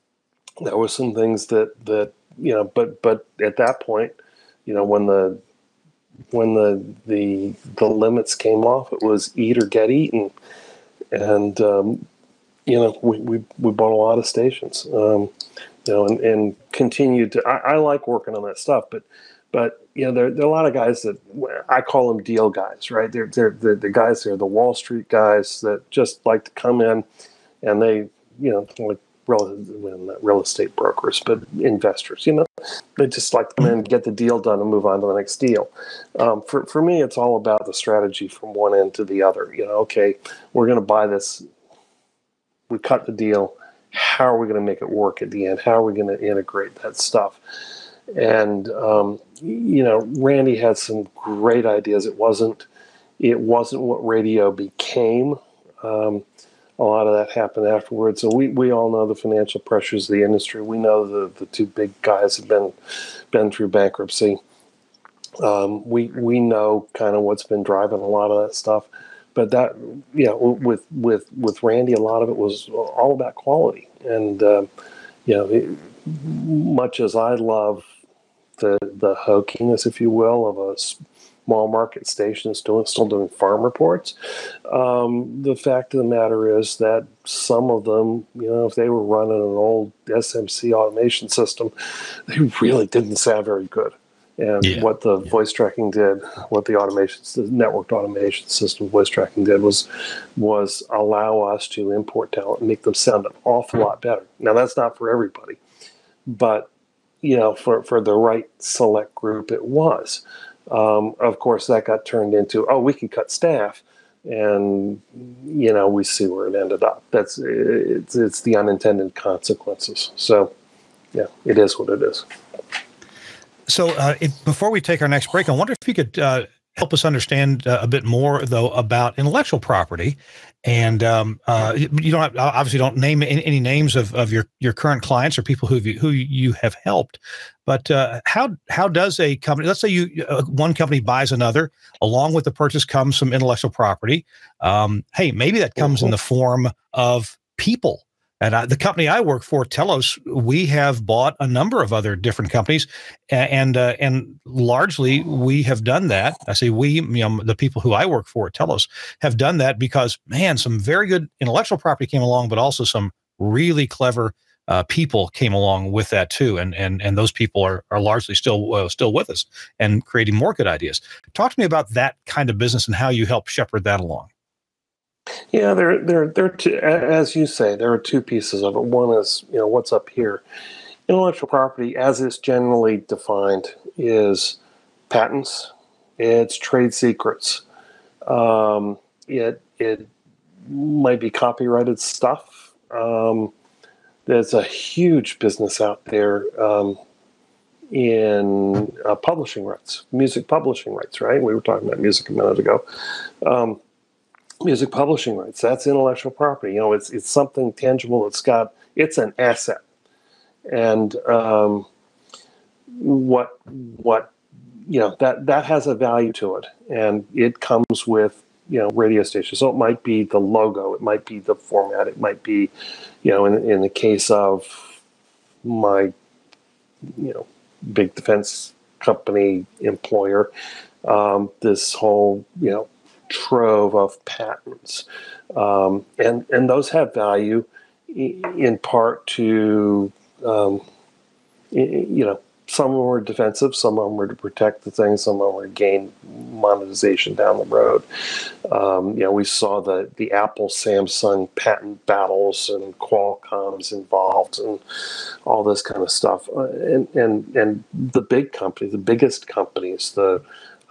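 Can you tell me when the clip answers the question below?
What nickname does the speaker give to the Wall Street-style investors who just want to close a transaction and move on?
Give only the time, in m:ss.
0:22.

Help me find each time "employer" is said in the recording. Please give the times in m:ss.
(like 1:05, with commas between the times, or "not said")
3:49.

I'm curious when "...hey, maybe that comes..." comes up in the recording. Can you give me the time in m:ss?
2:25.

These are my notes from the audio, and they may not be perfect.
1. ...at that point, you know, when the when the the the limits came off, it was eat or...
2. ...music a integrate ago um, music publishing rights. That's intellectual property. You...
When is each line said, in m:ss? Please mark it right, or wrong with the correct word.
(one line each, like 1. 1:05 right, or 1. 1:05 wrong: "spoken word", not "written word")
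1. 0:03 right
2. 3:21 wrong: "minute", not "integrate".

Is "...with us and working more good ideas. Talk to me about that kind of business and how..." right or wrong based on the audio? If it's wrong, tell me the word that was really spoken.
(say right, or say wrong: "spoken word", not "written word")
wrong: "creating", not "working".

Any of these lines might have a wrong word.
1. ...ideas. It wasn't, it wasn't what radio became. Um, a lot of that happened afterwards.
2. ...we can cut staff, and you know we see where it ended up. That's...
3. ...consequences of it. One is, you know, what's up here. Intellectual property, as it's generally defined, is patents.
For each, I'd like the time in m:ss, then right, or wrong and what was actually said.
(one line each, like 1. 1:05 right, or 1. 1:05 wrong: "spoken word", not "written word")
1. 0:51 right
2. 1:52 right
3. 2:58 wrong: "pieces", not "consequences".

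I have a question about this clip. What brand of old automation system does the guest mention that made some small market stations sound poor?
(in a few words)
SMC.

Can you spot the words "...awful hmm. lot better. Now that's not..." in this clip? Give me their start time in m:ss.
1:43.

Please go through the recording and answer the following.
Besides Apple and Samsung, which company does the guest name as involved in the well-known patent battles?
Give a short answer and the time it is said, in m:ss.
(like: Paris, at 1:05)
Qualcomm, at 4:12.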